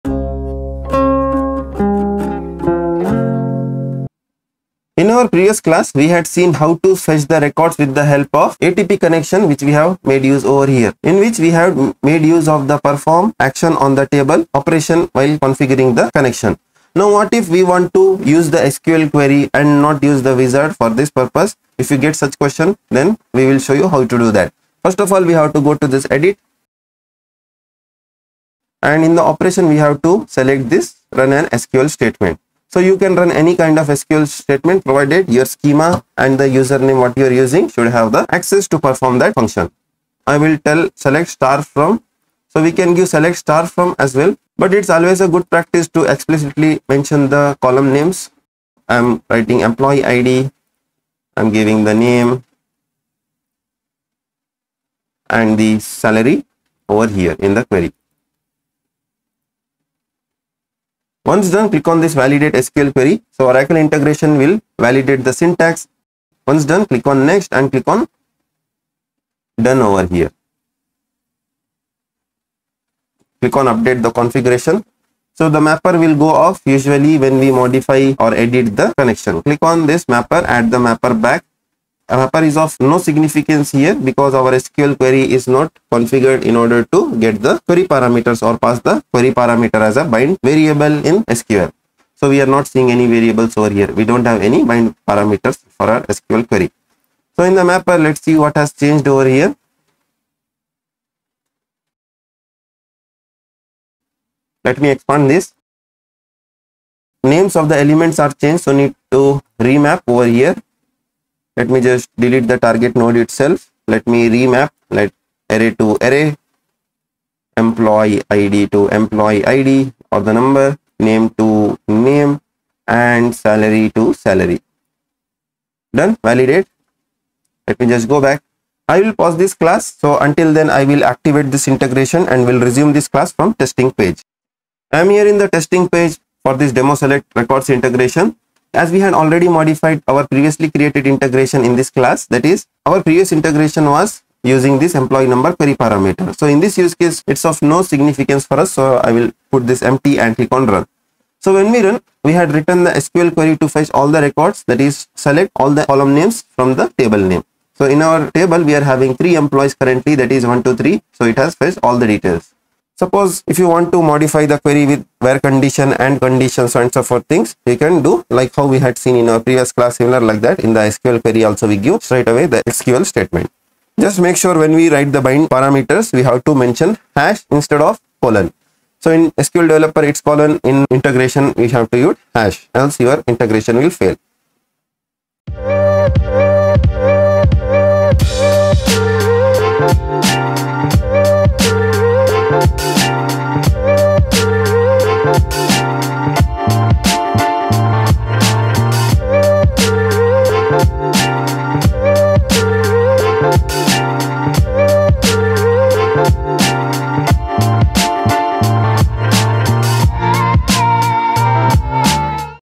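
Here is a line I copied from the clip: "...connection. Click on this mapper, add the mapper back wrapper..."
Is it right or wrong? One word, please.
right.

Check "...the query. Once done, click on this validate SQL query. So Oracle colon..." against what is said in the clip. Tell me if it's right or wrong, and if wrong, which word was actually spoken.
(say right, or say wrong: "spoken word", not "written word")
wrong: "integration", not "colon".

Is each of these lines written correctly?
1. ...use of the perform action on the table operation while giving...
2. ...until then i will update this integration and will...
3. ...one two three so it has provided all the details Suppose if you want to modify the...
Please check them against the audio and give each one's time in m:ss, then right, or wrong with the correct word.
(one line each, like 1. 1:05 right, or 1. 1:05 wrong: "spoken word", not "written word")
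1. 0:12 wrong: "configuring", not "giving"
2. 2:10 wrong: "activate", not "update"
3. 2:40 wrong: "fetched", not "provided".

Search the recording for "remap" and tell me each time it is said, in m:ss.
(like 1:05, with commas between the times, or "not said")
1:49, 1:54.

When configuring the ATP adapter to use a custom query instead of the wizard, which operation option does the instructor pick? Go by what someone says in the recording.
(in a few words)
Run an SQL statement.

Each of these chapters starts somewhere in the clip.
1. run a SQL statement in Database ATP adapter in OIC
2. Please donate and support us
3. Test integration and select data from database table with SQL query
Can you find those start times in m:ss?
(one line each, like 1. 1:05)
1. 0:22
2. 3:04
3. 2:14.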